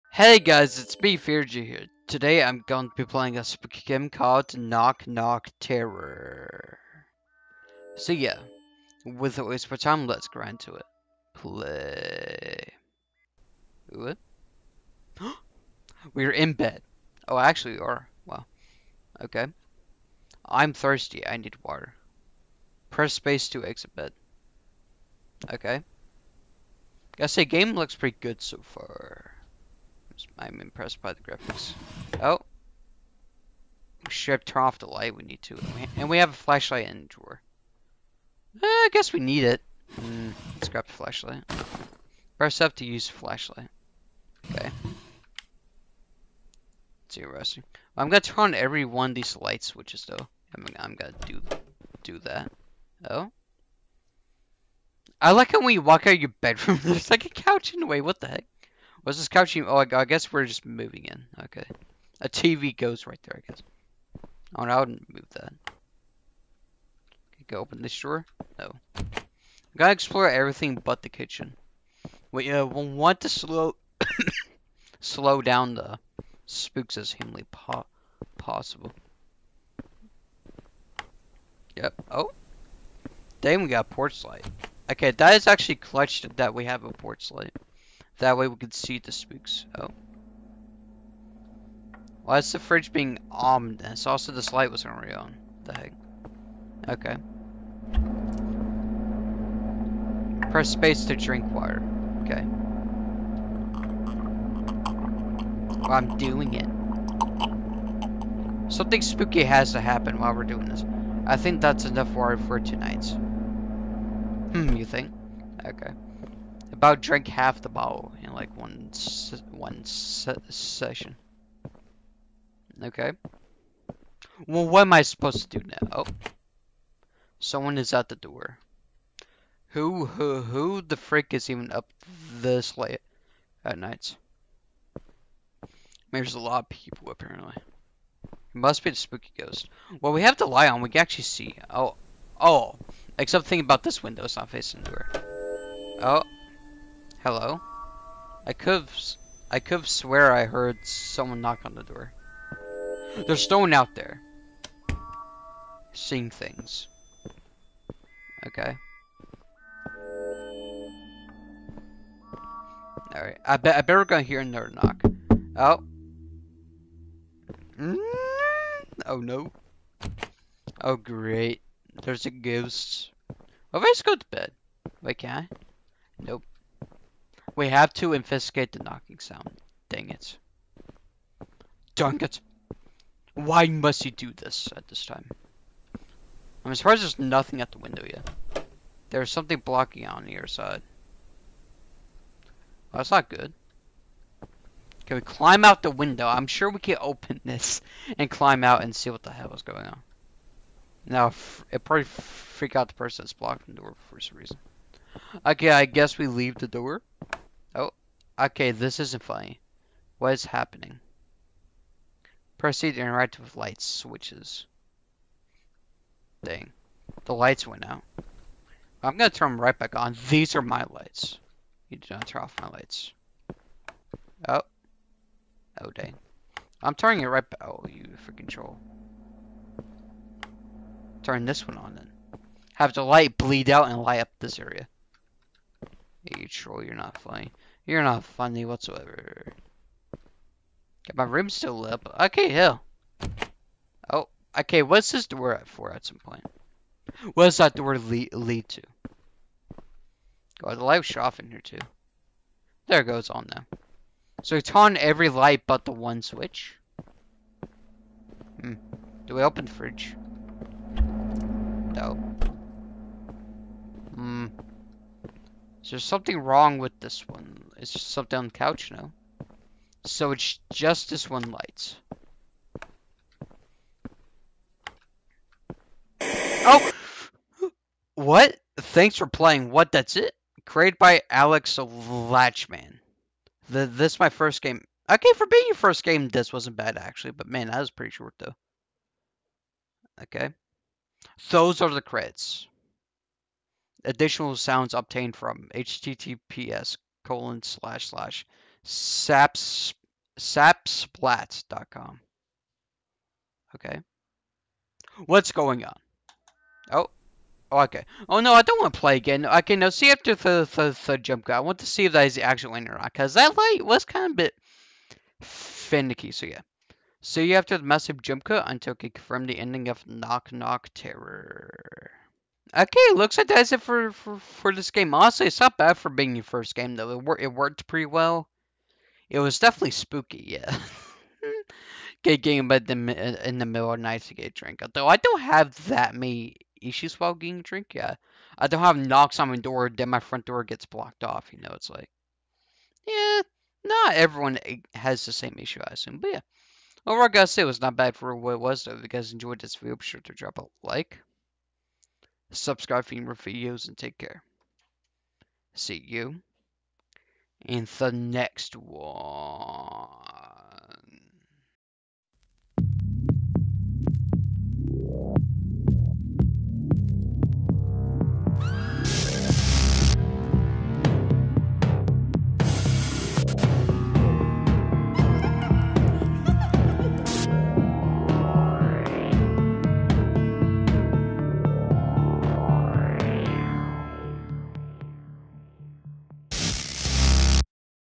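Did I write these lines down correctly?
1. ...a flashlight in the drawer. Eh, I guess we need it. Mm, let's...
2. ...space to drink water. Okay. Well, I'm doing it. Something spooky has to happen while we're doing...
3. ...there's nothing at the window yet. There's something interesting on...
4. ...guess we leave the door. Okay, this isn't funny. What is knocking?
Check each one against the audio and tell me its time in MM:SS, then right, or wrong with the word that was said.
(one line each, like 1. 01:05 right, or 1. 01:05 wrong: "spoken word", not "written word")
1. 00:36 right
2. 01:40 right
3. 03:07 wrong: "blocking", not "interesting"
4. 03:25 wrong: "happening", not "knocking".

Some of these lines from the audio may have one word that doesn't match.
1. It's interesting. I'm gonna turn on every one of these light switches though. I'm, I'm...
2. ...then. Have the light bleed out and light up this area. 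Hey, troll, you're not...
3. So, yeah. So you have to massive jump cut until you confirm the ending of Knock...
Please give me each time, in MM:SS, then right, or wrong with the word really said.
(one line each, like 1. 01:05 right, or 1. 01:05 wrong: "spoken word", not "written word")
1. 00:47 right
2. 03:51 right
3. 05:16 right.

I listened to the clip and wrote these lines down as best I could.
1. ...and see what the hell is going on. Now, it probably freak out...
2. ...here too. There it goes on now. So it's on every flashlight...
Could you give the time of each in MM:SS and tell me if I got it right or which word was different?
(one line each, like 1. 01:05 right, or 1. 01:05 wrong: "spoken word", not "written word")
1. 03:18 right
2. 04:11 wrong: "light", not "flashlight".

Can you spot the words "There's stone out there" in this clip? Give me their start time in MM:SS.
02:33.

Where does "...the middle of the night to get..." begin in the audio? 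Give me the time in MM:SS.
05:33.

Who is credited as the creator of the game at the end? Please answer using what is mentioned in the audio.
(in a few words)
Alex Latchman.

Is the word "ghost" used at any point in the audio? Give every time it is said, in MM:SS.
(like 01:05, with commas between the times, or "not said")
02:19, 02:52.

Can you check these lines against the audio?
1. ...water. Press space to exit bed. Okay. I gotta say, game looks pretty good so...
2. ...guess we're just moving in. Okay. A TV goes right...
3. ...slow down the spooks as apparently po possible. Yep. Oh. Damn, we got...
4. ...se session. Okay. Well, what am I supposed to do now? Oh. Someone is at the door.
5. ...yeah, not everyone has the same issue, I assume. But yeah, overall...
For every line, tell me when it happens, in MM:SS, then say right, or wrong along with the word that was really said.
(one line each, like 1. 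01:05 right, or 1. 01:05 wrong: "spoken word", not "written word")
1. 00:21 right
2. 01:00 right
3. 01:14 wrong: "humanly", not "apparently"
4. 01:59 right
5. 05:43 right.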